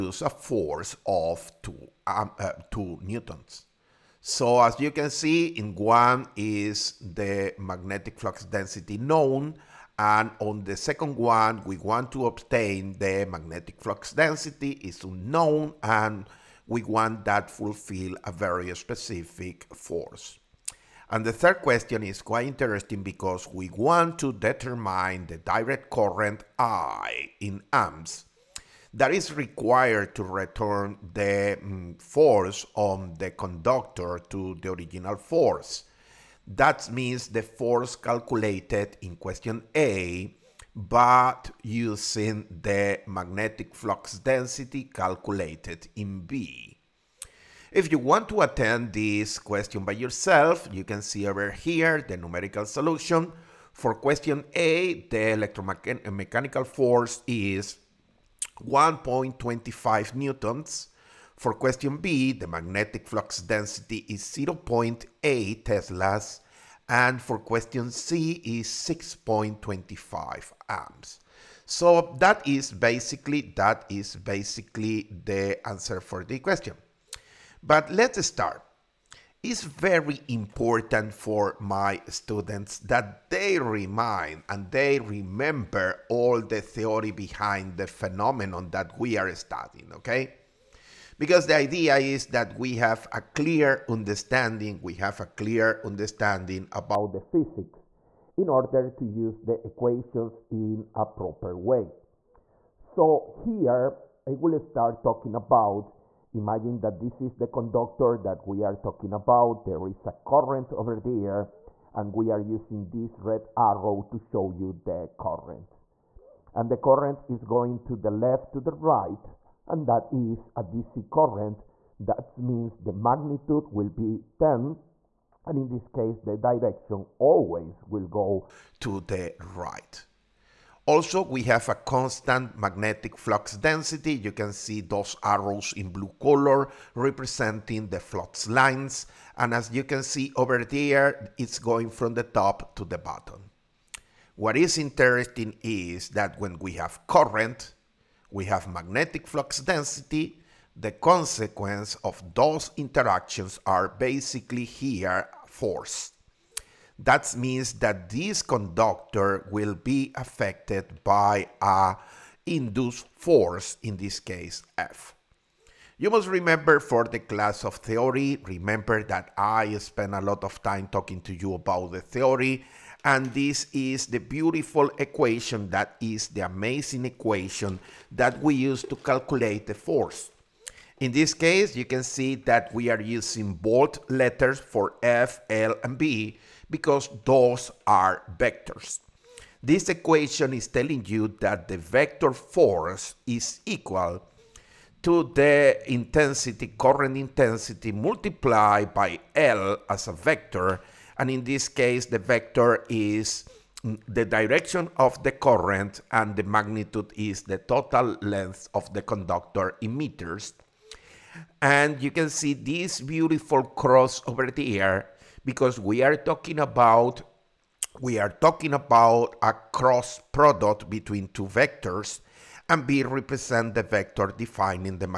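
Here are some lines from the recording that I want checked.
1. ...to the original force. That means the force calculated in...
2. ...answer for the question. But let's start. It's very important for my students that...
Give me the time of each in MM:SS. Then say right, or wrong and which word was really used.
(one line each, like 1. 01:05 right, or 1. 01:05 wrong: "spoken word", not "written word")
1. 00:34 right
2. 01:15 right.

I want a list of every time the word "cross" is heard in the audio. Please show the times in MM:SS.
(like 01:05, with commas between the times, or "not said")
03:33, 03:39.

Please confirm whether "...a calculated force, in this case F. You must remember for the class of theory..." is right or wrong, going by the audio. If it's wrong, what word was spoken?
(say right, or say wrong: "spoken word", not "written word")
wrong: "induced", not "calculated".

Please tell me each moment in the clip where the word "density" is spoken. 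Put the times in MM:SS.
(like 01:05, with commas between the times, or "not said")
00:08, 00:14, 00:44, 01:03, 02:13, 02:29.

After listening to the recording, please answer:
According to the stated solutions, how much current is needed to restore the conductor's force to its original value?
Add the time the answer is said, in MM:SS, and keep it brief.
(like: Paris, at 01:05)
6.25 amps, at 01:08.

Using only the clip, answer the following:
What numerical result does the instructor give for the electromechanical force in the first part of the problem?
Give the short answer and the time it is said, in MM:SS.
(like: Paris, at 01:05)
1.25 newtons, at 00:58.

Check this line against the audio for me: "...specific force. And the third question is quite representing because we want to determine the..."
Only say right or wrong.
wrong.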